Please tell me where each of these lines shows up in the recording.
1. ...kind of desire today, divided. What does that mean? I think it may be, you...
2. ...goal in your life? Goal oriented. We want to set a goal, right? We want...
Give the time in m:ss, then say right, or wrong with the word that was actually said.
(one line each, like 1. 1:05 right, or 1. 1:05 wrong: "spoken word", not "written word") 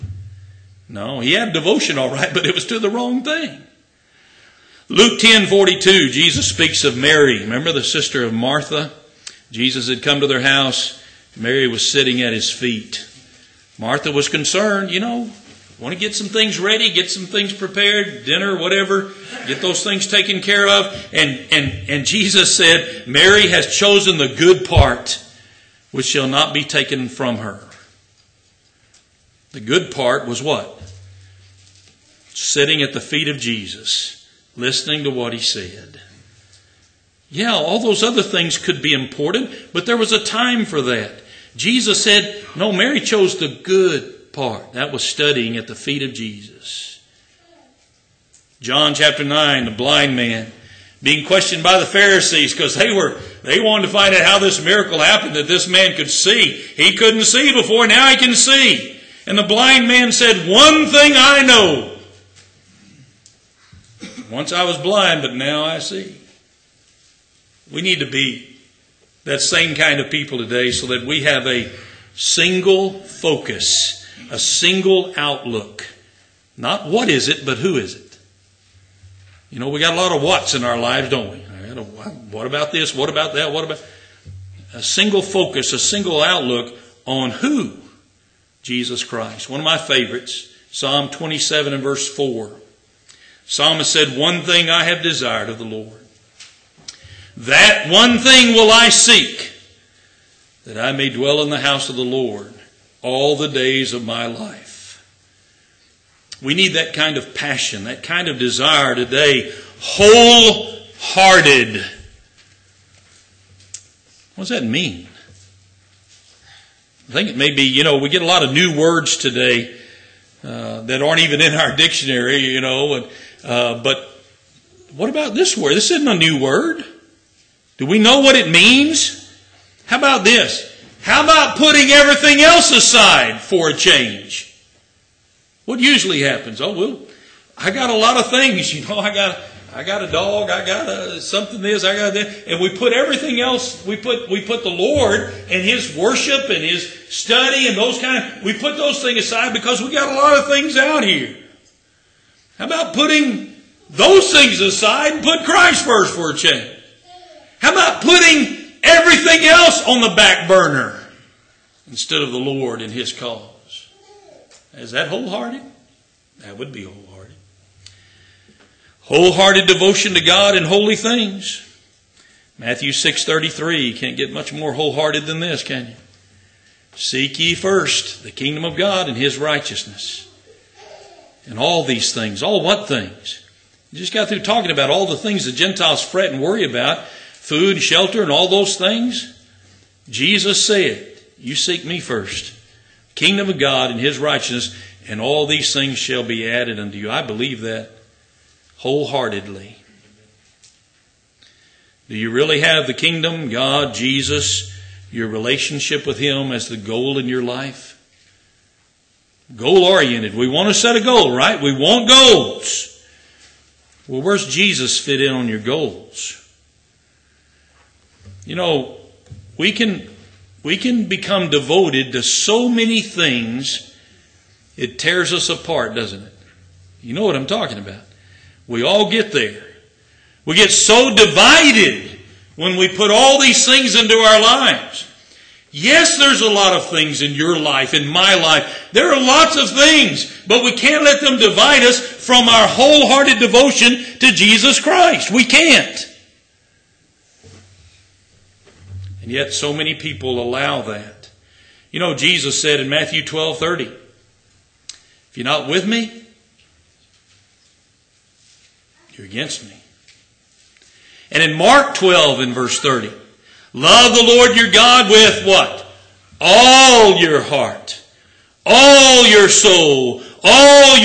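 1. 1:48 wrong: "wholehearted", not "divided"
2. 3:26 right.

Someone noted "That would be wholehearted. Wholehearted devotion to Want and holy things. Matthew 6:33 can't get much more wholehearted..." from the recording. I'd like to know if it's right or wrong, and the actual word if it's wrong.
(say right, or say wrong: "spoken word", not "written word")
wrong: "God", not "Want".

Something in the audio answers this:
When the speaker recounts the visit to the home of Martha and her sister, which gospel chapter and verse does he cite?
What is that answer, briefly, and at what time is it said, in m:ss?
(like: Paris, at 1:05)
Luke 10:42, at 0:04.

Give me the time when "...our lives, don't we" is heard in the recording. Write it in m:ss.
1:20.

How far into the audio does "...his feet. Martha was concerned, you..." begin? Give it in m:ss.
0:12.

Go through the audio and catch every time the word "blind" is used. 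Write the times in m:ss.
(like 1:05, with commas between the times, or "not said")
0:49, 0:59, 1:04.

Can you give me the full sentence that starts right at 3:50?
We get so divided when we put all these things into our lives.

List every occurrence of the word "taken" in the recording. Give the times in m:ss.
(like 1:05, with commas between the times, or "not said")
0:20, 0:26.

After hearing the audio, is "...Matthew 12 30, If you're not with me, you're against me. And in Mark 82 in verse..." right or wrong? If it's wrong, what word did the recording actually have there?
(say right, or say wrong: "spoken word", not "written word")
wrong: "12", not "82".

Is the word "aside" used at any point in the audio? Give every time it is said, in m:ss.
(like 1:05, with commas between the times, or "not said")
2:12, 2:29, 2:34.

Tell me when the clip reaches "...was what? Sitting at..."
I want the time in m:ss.
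0:30.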